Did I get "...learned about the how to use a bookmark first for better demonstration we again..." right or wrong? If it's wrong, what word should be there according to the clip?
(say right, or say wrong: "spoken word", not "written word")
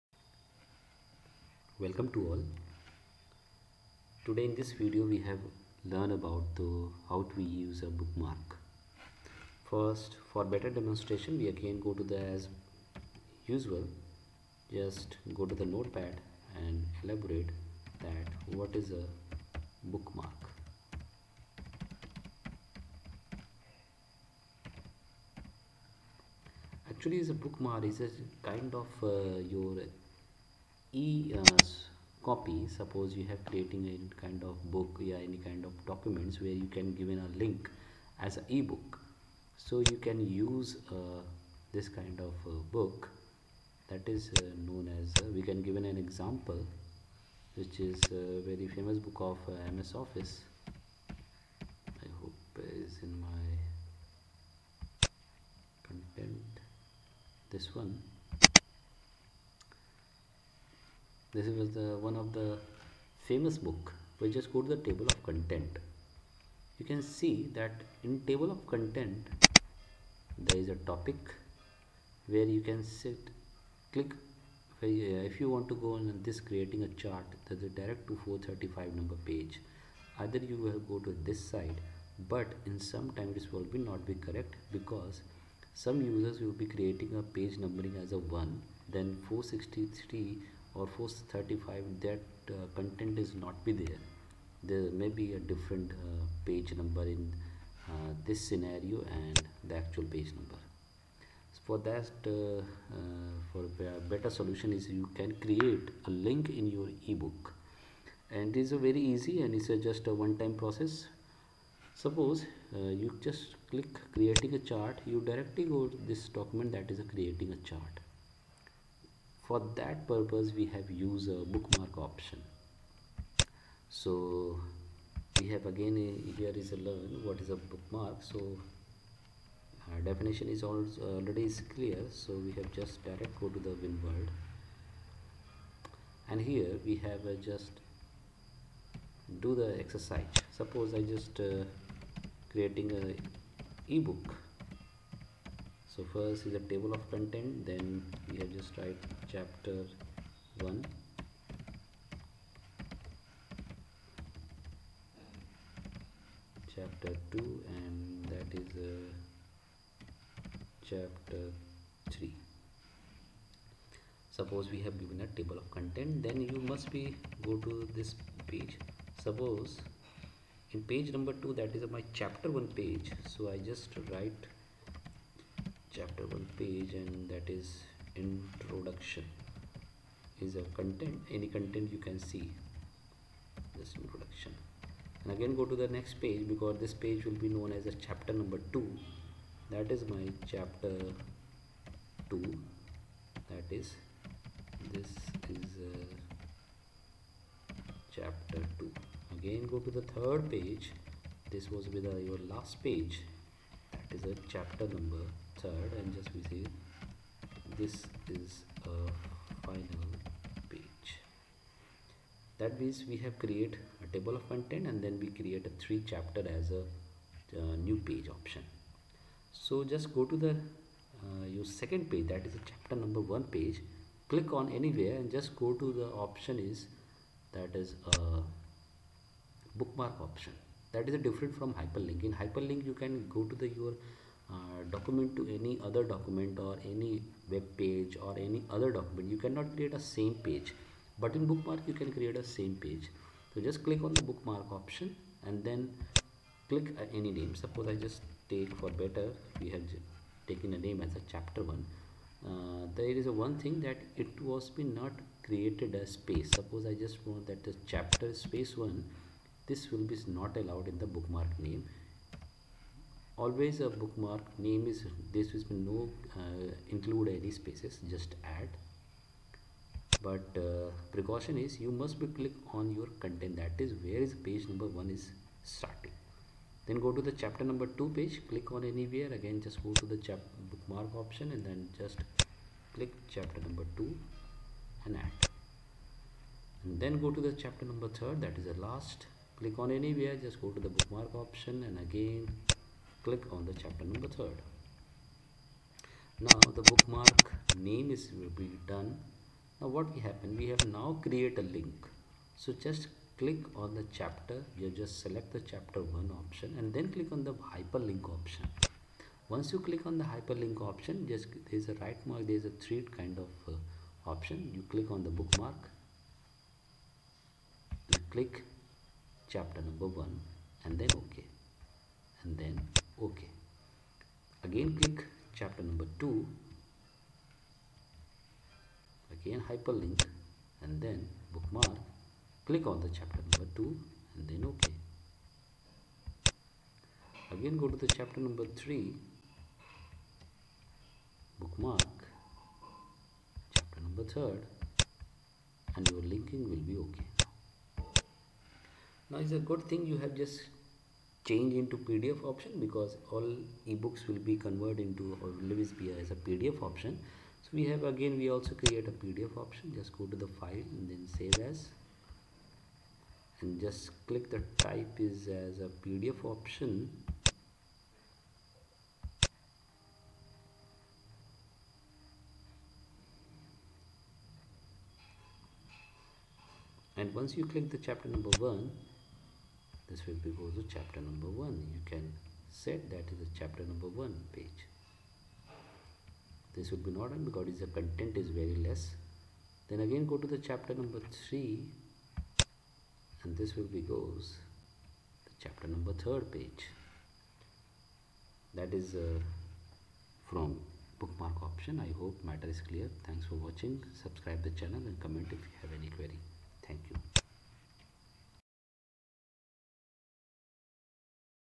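right.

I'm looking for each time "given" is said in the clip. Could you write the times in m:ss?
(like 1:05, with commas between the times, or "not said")
0:36, 0:45, 2:45.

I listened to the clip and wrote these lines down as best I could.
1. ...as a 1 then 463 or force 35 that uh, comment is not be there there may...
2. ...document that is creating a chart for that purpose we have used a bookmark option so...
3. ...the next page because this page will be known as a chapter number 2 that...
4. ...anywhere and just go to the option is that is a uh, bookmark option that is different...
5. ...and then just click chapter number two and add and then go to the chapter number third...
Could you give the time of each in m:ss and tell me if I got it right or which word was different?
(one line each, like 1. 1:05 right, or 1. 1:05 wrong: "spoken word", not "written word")
1. 1:28 wrong: "content", not "comment"
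2. 1:56 right
3. 3:05 right
4. 3:44 right
5. 4:41 right.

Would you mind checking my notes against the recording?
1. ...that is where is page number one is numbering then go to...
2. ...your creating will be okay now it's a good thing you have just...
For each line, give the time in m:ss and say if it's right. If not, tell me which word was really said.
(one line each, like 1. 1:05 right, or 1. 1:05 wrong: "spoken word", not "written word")
1. 4:33 wrong: "starting", not "numbering"
2. 5:46 wrong: "linking", not "creating".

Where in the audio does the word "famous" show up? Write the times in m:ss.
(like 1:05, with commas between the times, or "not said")
0:48, 1:03.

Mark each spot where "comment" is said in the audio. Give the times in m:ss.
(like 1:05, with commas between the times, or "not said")
6:45.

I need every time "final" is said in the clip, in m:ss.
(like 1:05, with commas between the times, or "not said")
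3:29.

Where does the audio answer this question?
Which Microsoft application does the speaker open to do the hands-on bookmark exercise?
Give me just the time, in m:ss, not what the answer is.
2:13.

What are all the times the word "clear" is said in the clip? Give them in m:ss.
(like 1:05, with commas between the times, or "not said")
2:11, 6:42.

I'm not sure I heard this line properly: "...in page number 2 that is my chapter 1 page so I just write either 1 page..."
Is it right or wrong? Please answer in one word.
wrong.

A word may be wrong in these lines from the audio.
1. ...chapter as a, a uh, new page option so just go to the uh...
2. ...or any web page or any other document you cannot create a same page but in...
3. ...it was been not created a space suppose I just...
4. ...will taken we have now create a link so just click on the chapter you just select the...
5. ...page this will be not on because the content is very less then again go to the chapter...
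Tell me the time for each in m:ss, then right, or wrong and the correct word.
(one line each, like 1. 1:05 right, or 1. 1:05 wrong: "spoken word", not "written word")
1. 3:36 right
2. 3:56 right
3. 4:14 right
4. 5:00 wrong: "happen", not "taken"
5. 6:24 right.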